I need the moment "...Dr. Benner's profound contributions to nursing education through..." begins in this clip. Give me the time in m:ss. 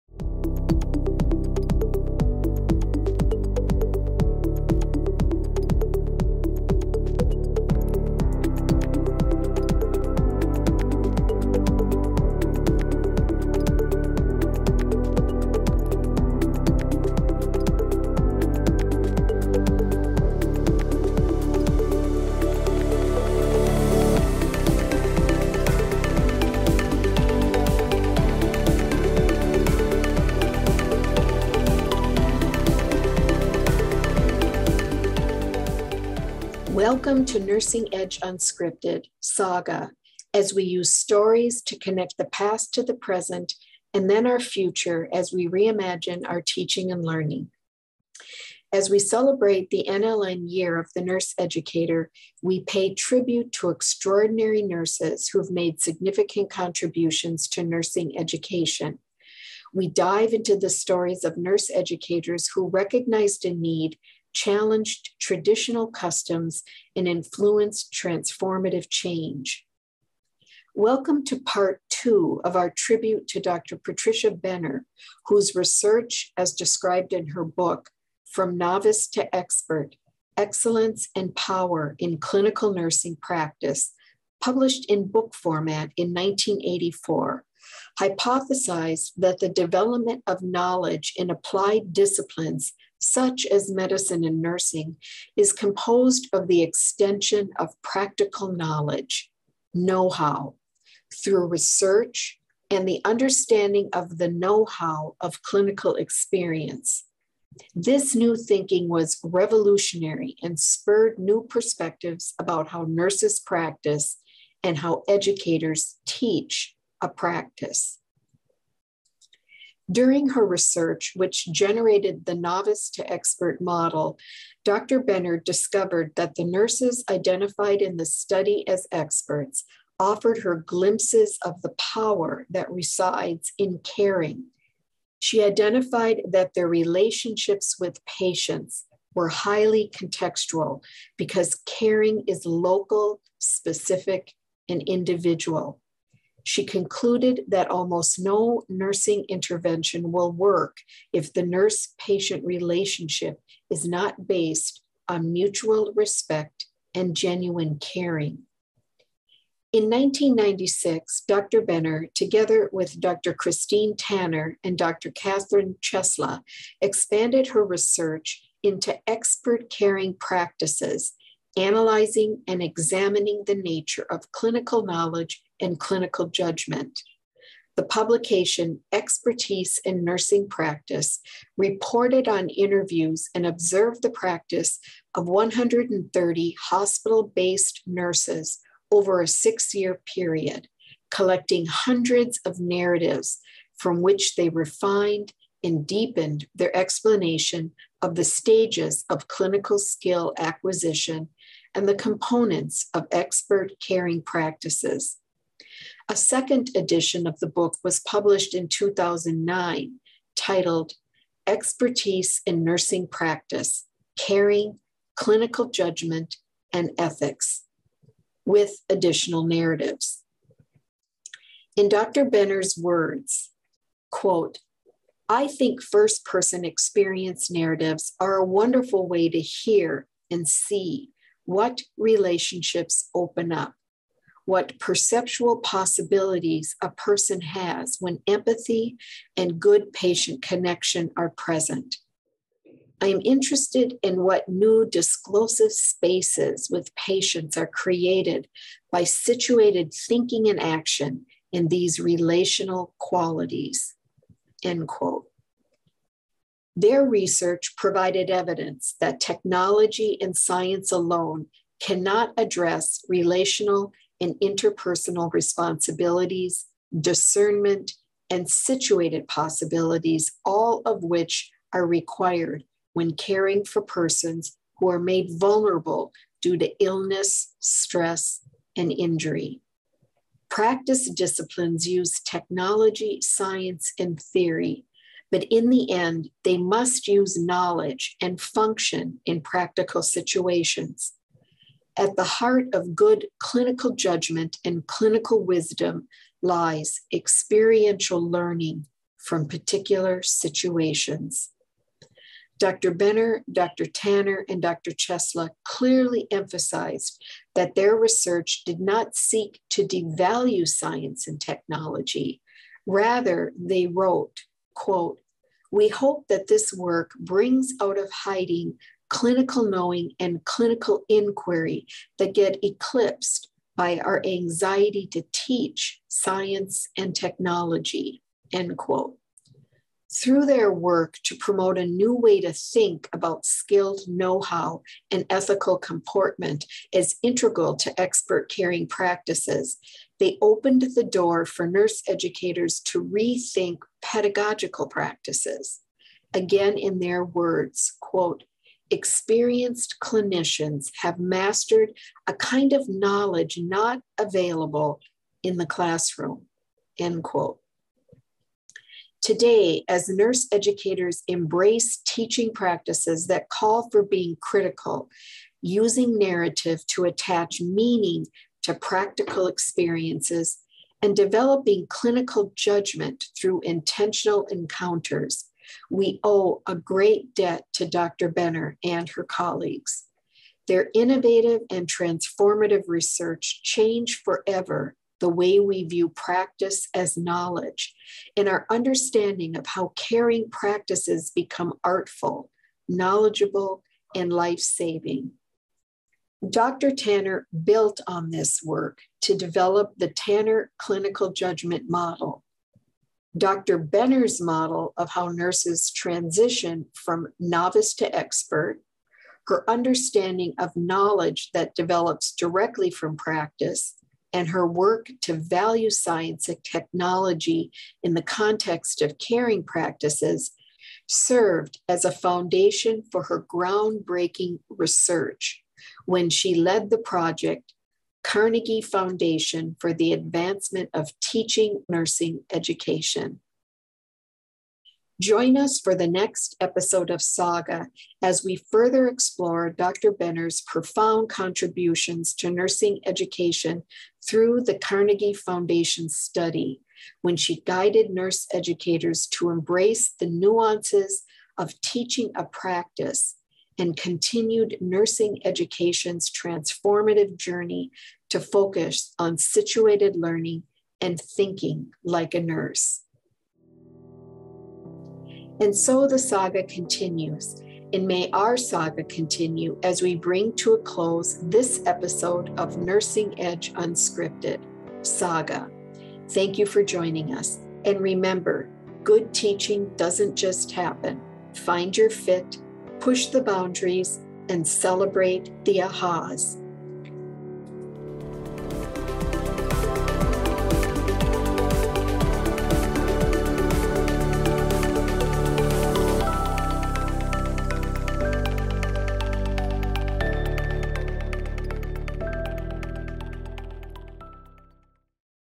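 7:19.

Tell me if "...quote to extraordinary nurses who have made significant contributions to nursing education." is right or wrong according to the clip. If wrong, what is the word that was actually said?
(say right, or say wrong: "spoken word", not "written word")
wrong: "tribute", not "quote".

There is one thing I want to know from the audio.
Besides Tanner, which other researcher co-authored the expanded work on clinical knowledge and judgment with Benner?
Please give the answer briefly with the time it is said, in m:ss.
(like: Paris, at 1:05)
Dr. Catherine Chesla, at 2:45.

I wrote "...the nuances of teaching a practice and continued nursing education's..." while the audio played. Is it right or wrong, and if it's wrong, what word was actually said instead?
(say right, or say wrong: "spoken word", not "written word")
right.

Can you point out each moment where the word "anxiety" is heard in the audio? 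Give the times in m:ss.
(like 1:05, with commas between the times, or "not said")
5:24.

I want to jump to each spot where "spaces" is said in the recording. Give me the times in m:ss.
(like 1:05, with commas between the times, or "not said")
4:05.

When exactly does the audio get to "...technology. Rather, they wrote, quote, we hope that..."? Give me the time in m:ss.
5:11.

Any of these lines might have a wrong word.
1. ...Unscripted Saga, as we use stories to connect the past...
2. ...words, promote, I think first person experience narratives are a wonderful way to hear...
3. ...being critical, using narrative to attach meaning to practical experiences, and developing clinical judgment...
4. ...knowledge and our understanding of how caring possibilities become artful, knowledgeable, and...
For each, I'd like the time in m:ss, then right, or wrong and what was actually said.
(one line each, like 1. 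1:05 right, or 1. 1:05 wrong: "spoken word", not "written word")
1. 0:38 right
2. 3:42 wrong: "quote", not "promote"
3. 6:04 right
4. 6:27 wrong: "practices", not "possibilities".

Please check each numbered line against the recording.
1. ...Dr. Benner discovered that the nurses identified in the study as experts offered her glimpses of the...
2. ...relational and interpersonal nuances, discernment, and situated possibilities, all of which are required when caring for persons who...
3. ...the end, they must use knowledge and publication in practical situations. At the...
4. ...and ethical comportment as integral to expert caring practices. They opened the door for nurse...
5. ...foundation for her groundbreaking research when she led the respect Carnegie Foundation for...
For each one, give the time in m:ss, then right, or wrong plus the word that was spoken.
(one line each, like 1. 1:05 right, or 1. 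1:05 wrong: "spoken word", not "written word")
1. 2:04 right
2. 4:23 wrong: "responsibilities", not "nuances"
3. 4:45 wrong: "function", not "publication"
4. 5:35 right
5. 7:02 wrong: "project", not "respect".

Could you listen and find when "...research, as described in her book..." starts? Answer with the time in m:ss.
1:15.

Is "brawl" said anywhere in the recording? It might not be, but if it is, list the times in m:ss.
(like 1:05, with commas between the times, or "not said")
not said.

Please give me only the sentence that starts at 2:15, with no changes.
She identified that their relationships with patients were highly contextual because caring is local, specific, and individual.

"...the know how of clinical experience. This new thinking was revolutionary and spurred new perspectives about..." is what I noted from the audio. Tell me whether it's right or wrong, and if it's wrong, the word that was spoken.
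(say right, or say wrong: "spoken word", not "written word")
right.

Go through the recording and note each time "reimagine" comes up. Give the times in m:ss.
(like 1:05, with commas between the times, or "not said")
0:45.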